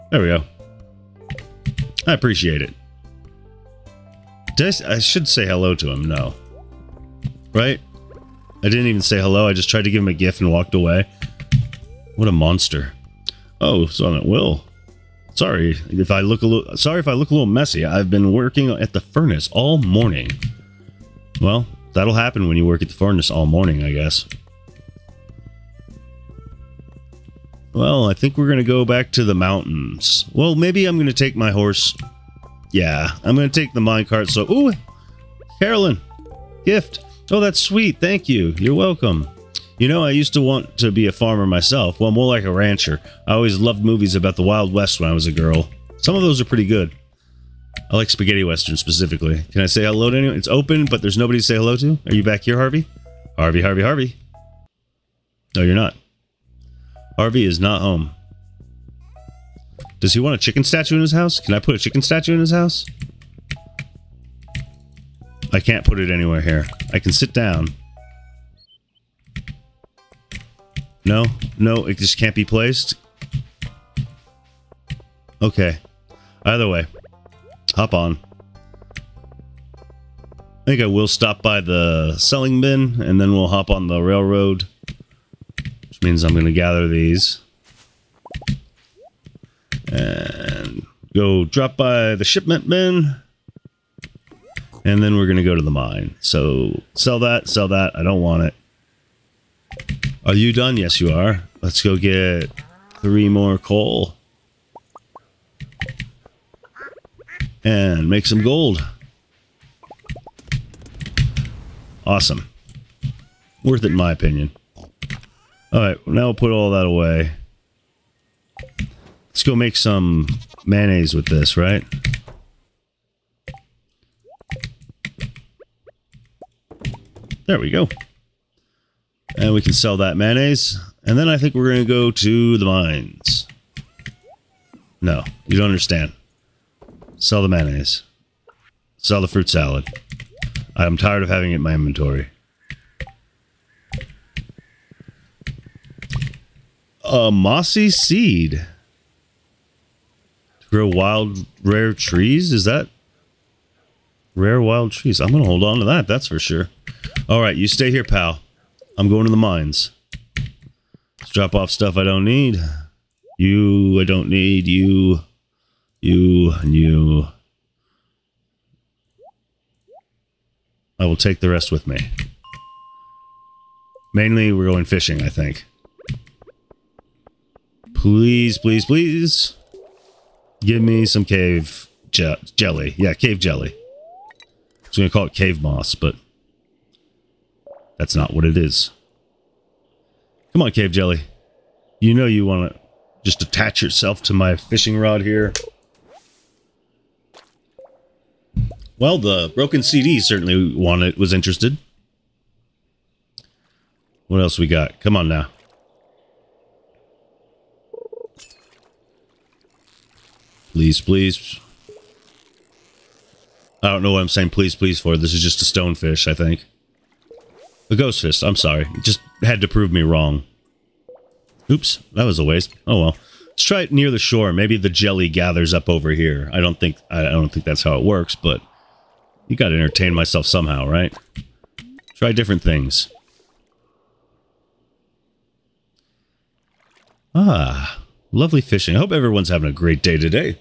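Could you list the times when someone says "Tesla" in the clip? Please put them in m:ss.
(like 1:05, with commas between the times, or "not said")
not said.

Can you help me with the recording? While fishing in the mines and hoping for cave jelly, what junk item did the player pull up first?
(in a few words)
Broken CD.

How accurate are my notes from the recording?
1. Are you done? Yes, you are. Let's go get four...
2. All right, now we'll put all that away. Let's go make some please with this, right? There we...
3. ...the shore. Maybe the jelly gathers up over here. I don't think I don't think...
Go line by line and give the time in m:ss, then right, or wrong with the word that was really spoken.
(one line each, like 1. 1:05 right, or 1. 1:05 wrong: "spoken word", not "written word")
1. 1:40 wrong: "three", not "four"
2. 1:55 wrong: "mayonnaise", not "please"
3. 3:44 right.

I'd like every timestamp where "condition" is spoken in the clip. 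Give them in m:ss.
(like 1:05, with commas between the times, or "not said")
not said.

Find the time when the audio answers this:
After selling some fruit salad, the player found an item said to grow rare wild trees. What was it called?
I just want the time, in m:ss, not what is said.
2:27.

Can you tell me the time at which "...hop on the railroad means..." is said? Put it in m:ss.
1:23.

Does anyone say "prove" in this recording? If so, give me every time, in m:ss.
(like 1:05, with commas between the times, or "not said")
3:39.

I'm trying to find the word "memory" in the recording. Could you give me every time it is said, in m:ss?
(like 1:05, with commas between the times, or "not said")
not said.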